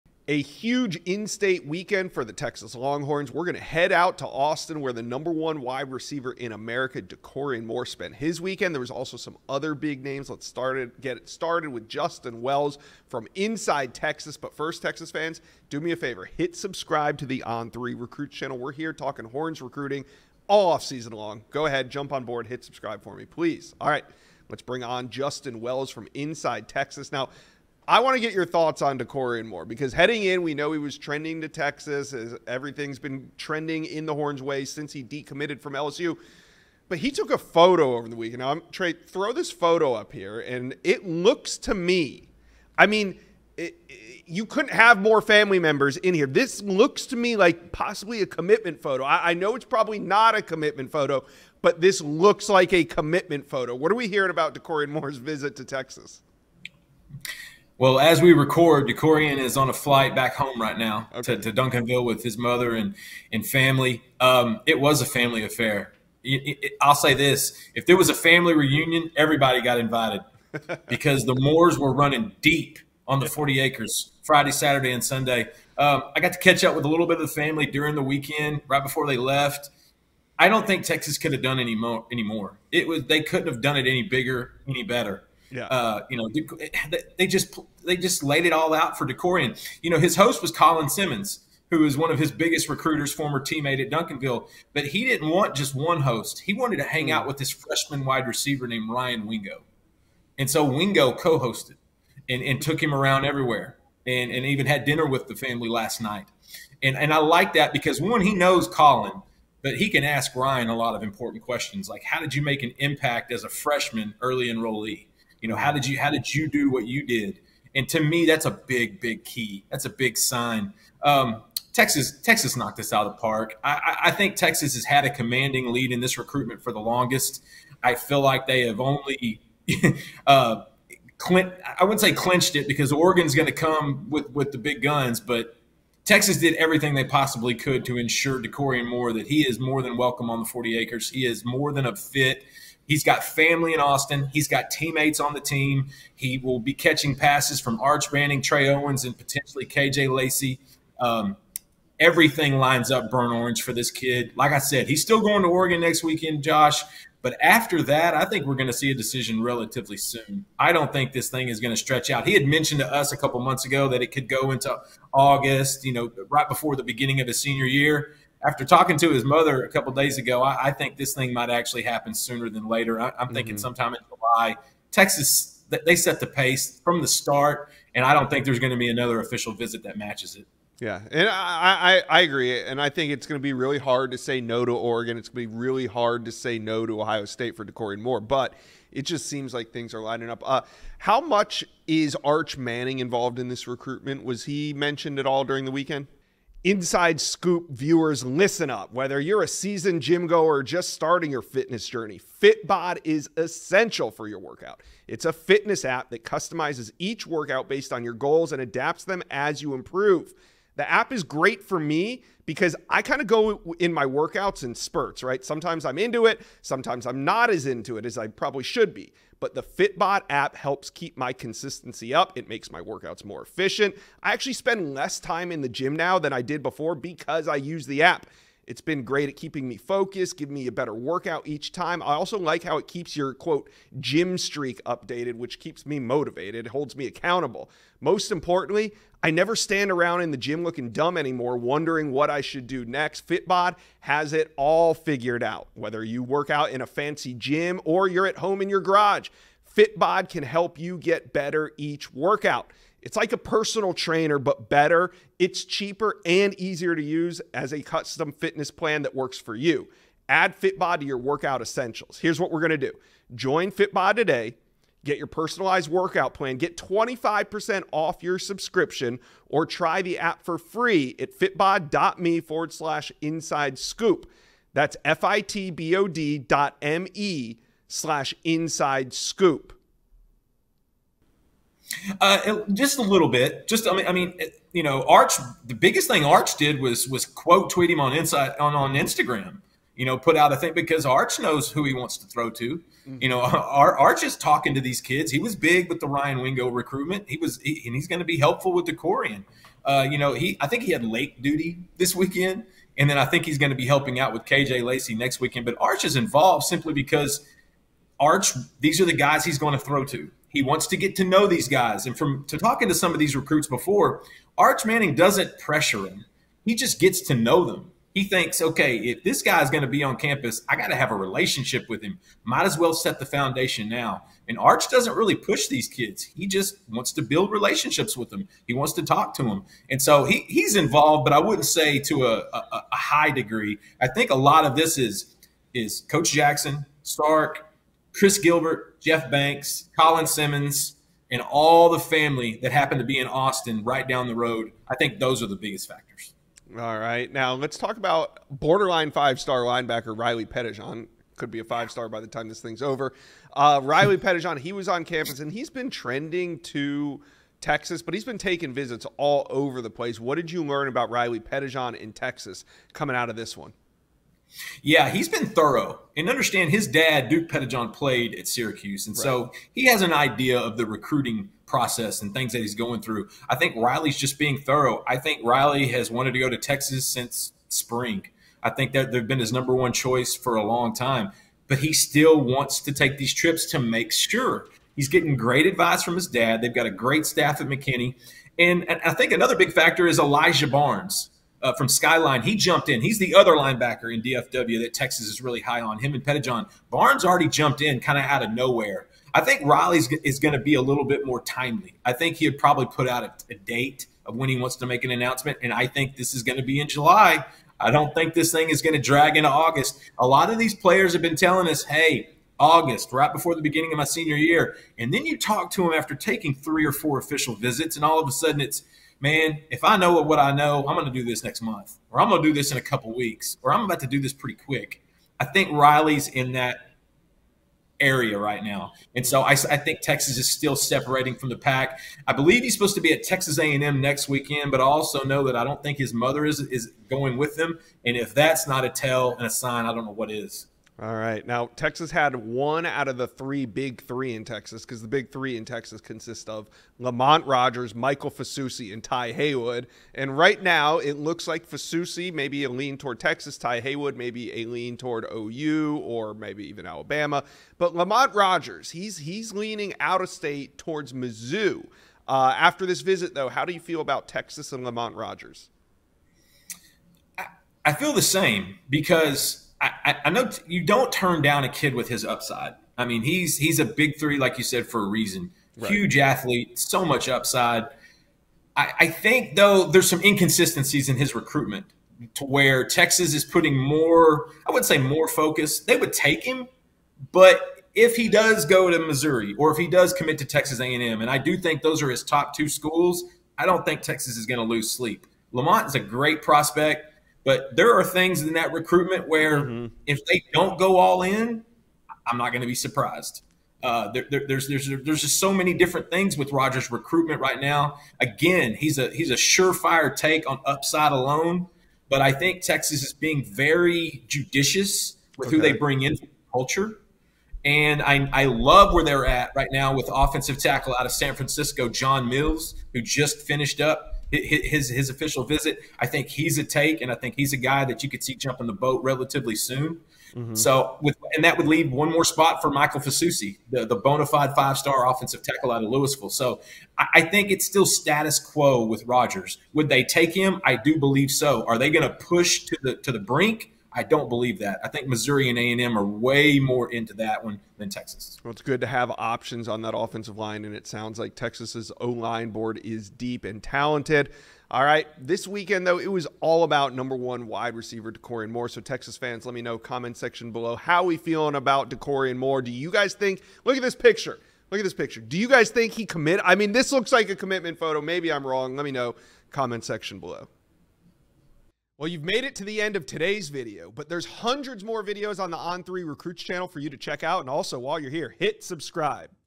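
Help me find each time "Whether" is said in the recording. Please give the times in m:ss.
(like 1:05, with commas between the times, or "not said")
3:18, 4:05.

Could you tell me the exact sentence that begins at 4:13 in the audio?
It's like a personal trainer, but better.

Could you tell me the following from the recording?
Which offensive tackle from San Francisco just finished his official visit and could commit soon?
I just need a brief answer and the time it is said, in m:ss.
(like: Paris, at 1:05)
John Mills, at 8:41.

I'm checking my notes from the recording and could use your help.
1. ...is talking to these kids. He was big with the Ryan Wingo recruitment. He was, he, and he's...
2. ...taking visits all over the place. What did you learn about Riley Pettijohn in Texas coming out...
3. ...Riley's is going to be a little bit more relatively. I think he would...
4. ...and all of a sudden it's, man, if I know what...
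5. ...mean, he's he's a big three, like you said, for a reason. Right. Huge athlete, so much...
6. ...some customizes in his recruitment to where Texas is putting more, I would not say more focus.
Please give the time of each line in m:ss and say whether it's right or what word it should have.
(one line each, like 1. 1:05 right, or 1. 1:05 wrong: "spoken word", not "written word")
1. 4:54 right
2. 5:58 right
3. 6:39 wrong: "timely", not "relatively"
4. 6:57 right
5. 7:53 right
6. 8:00 wrong: "inconsistencies", not "customizes".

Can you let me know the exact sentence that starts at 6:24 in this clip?
He's getting great advice from his dad.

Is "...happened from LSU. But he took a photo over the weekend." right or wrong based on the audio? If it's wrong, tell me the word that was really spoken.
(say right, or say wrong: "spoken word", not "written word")
wrong: "decommitted", not "happened".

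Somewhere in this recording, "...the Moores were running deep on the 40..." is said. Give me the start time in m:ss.
1:11.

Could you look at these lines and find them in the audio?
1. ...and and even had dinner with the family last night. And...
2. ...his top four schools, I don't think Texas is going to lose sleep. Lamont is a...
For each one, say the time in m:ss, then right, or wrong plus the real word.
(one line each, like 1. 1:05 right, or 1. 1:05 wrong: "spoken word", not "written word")
1. 1:44 right
2. 8:12 wrong: "two", not "four".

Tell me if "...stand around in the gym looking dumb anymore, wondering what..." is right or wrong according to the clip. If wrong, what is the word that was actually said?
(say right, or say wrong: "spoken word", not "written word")
right.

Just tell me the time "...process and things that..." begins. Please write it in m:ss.
6:11.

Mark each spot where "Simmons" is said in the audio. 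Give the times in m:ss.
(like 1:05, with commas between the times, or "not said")
1:30, 5:40.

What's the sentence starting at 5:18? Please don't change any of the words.
He thinks, okay, if this guy's going to be on campus, I got to have a relationship with him.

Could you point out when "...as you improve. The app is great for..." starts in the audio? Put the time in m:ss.
3:29.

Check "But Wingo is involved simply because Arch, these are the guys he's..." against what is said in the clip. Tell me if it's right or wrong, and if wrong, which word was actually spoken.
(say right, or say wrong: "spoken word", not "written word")
wrong: "Arch", not "Wingo".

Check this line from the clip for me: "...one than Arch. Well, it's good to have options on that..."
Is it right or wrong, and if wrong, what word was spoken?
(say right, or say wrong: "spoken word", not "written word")
wrong: "Texas", not "Arch".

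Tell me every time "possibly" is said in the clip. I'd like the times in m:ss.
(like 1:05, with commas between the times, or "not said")
0:47, 2:17.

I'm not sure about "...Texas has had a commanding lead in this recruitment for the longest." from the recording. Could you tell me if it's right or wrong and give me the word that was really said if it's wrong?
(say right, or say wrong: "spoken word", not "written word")
right.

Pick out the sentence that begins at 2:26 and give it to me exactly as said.
He will be catching passes from Arch Manning, Trey Owens, and potentially KJ Lacy.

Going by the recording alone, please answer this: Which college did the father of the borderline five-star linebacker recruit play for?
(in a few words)
Syracuse.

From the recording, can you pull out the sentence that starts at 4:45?
The biggest thing Arch did was was quote tweet him on inside on on Instagram.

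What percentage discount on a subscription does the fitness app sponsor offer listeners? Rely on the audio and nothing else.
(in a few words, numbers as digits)
25%.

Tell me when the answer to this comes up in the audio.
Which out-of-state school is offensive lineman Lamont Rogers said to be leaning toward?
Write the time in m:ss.
7:41.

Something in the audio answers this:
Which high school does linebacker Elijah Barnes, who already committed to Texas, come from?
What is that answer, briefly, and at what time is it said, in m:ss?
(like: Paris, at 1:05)
Skyline, at 6:31.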